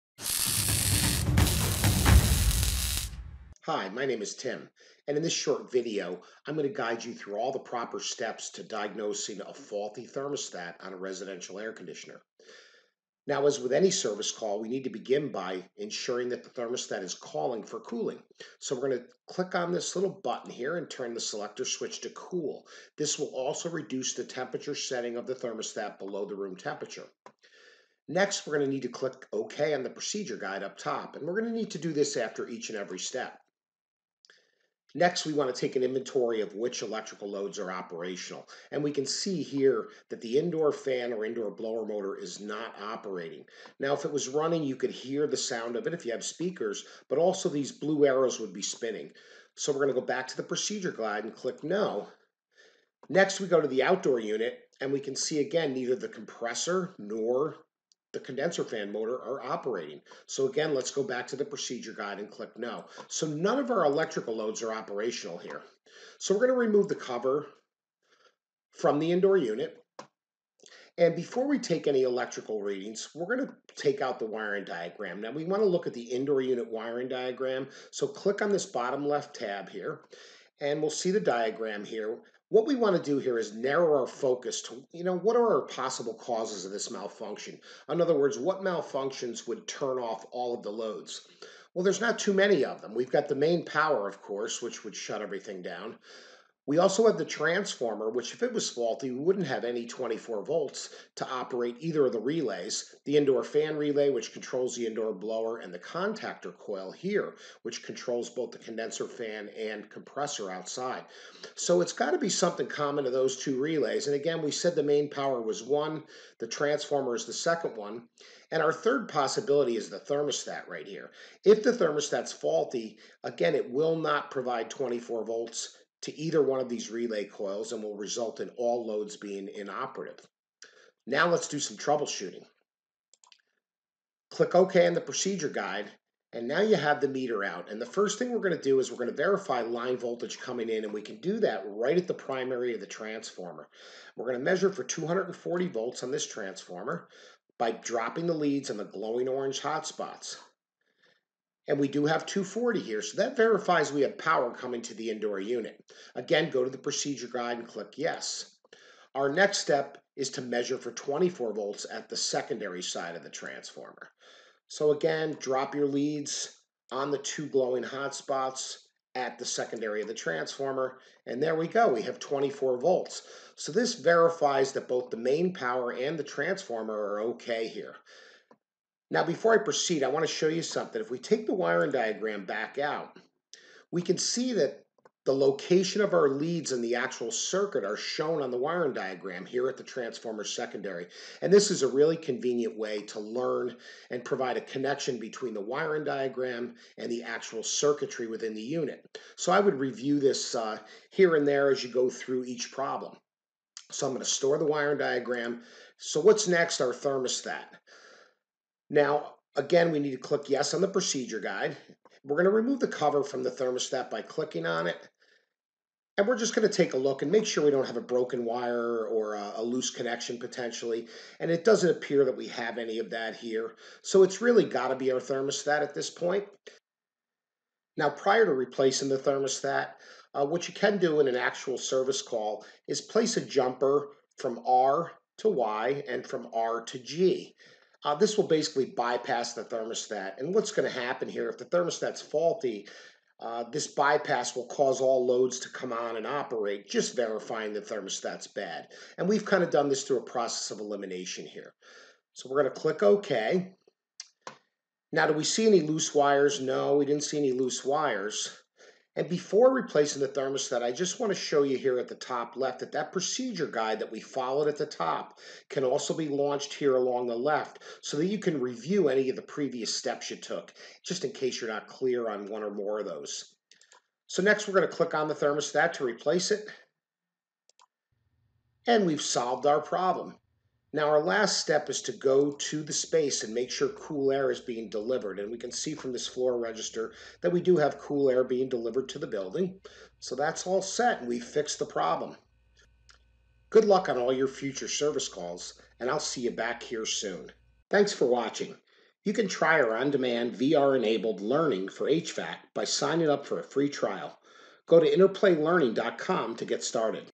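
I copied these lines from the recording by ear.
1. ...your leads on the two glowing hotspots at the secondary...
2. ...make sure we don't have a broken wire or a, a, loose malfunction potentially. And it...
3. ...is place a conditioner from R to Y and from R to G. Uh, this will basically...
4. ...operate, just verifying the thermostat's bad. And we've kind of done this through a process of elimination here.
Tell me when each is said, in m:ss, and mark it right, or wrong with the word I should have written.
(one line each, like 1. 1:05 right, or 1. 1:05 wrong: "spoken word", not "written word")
1. 2:45 right
2. 3:37 wrong: "connection", not "malfunction"
3. 3:52 wrong: "jumper", not "conditioner"
4. 4:06 right.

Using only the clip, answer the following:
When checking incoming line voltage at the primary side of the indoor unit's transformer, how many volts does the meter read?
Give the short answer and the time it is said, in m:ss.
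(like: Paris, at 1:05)
240, at 2:24.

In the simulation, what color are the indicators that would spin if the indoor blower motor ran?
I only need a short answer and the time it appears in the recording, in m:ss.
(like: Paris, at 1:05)
Blue, at 0:47.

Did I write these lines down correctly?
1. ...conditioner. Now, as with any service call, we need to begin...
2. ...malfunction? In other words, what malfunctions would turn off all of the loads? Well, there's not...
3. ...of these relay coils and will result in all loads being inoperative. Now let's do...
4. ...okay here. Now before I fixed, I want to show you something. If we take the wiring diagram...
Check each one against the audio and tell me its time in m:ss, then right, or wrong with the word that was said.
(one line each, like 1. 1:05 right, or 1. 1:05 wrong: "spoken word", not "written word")
1. 0:11 right
2. 1:26 right
3. 2:06 right
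4. 2:57 wrong: "proceed", not "fixed".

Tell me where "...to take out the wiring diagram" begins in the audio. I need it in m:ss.
1:13.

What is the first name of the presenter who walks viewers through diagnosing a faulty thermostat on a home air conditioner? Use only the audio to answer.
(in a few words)
Tim.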